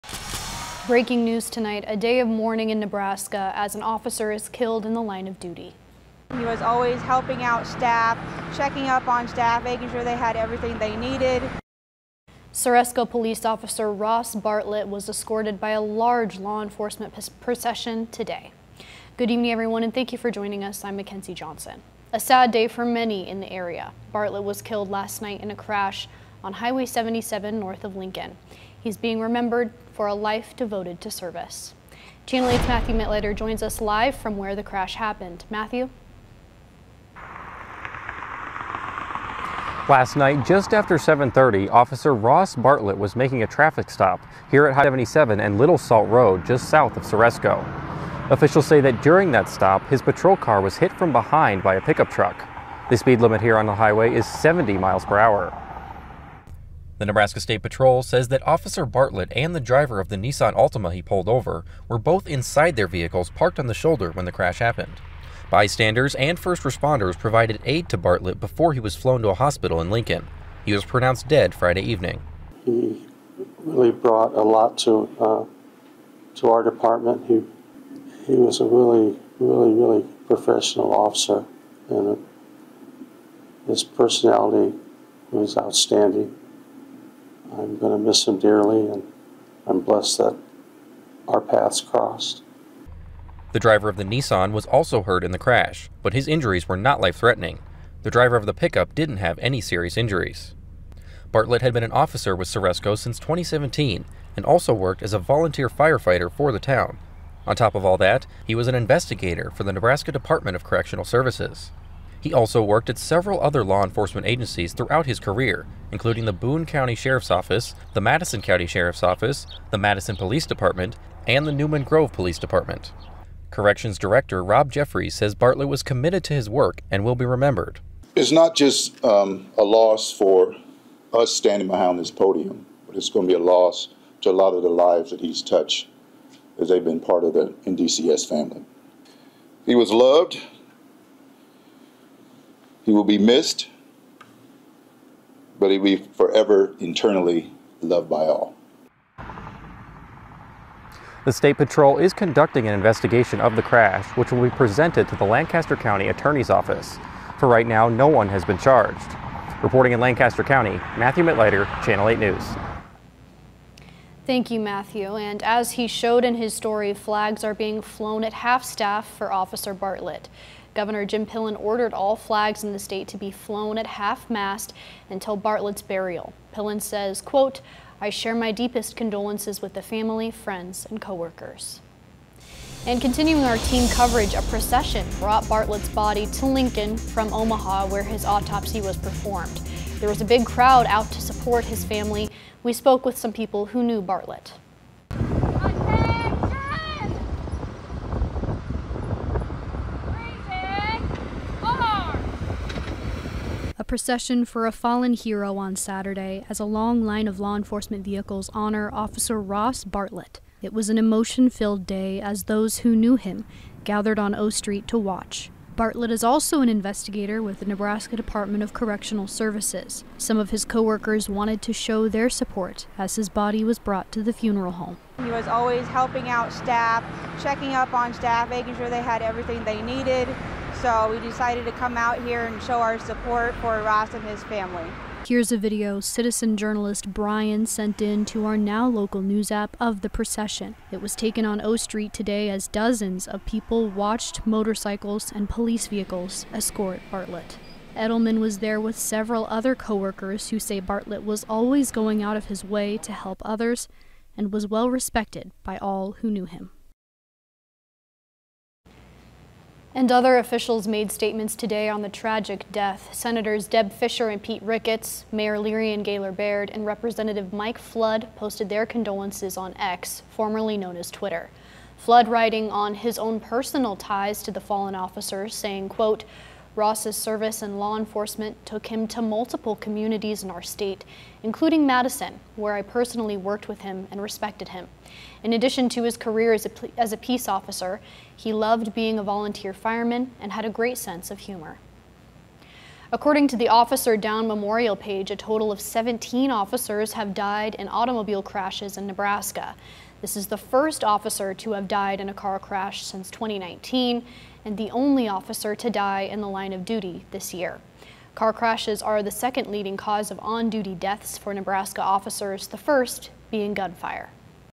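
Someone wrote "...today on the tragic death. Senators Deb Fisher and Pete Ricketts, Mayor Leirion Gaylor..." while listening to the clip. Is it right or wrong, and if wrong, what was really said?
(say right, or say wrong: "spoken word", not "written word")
right.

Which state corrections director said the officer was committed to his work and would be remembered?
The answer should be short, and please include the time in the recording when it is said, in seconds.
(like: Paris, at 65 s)
Rob Jeffreys, at 124 s.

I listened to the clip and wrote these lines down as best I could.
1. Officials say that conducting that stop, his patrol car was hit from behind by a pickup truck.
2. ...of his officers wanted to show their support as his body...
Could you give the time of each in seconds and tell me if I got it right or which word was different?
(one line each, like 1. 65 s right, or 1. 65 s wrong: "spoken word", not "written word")
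1. 48 s wrong: "during", not "conducting"
2. 220 s wrong: "coworkers", not "officers".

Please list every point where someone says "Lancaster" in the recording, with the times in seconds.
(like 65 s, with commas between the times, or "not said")
155 s, 159 s.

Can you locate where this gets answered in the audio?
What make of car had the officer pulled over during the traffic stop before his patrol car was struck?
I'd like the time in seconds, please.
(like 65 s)
60 s.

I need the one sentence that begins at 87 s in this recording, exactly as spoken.
I'm going to miss him dearly, and I'm blessed that our paths crossed.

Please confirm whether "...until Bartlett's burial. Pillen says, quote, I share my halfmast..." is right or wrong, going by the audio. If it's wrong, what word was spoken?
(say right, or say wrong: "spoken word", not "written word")
wrong: "deepest", not "halfmast".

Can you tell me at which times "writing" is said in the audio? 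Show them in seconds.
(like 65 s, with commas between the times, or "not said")
272 s.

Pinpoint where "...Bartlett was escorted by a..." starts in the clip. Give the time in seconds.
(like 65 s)
14 s.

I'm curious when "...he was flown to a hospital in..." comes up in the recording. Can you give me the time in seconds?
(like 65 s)
68 s.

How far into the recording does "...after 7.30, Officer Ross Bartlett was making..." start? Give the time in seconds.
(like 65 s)
40 s.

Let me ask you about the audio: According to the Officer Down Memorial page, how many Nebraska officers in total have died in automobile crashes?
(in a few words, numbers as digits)
17.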